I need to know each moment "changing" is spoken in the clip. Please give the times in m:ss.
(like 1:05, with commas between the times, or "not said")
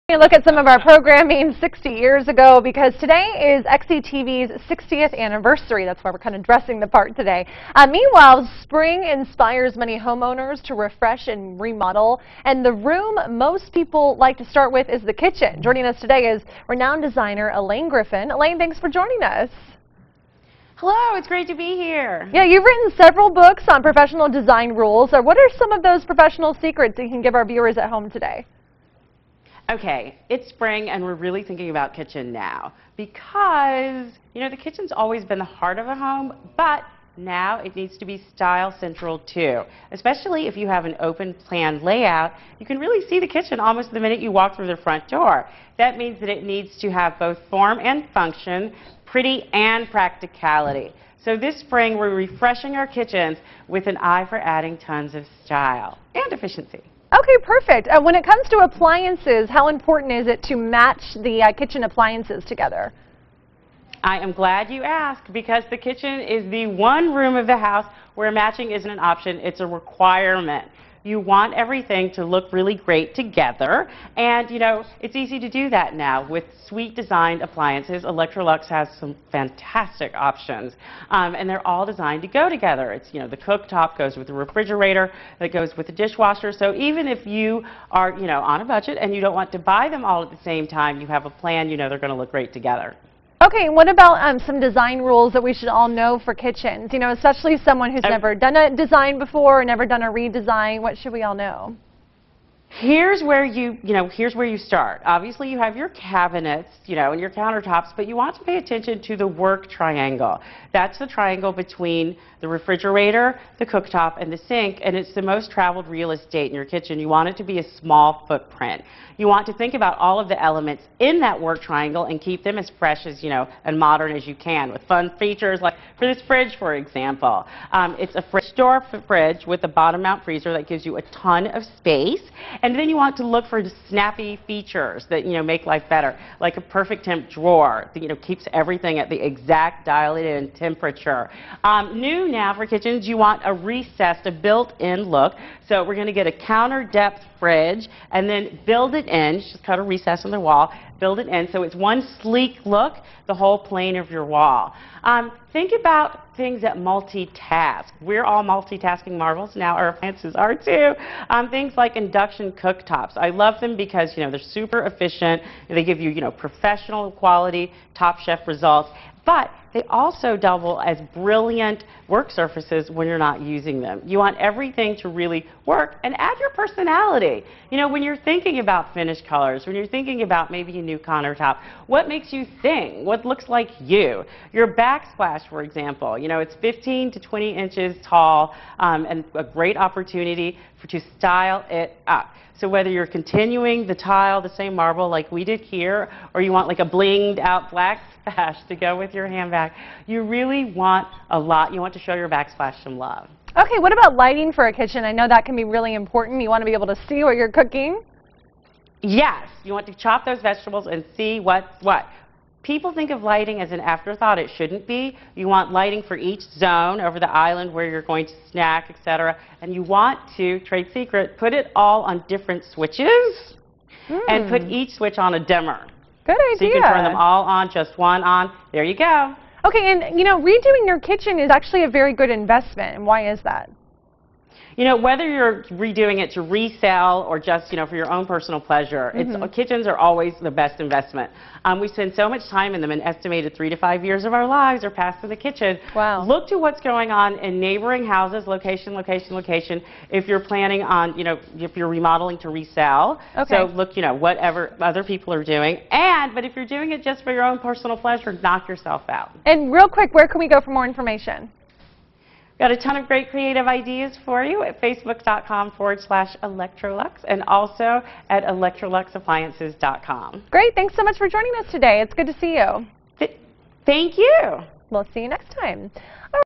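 not said.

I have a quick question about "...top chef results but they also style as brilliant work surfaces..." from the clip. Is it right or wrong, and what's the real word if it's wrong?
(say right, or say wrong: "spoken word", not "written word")
wrong: "double", not "style".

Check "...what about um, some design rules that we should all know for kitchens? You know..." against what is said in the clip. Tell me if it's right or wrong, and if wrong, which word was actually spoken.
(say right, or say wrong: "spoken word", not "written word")
right.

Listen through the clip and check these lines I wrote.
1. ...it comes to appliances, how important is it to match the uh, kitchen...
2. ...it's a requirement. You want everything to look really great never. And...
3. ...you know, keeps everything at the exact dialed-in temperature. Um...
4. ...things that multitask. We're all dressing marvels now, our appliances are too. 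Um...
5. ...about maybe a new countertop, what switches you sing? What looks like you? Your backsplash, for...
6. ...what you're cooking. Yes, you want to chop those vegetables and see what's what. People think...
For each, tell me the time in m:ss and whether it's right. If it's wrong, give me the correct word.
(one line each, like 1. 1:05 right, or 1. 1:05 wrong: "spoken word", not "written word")
1. 0:58 right
2. 1:09 wrong: "together", not "never"
3. 2:18 right
4. 2:36 wrong: "multitasking", not "dressing"
5. 3:00 wrong: "makes", not "switches"
6. 3:27 right.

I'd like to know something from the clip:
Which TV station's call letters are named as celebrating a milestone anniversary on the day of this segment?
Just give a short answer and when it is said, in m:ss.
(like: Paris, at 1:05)
XETV, at 0:03.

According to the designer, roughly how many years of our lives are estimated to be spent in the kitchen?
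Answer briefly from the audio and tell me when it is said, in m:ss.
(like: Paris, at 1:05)
3 to 5 years, at 4:03.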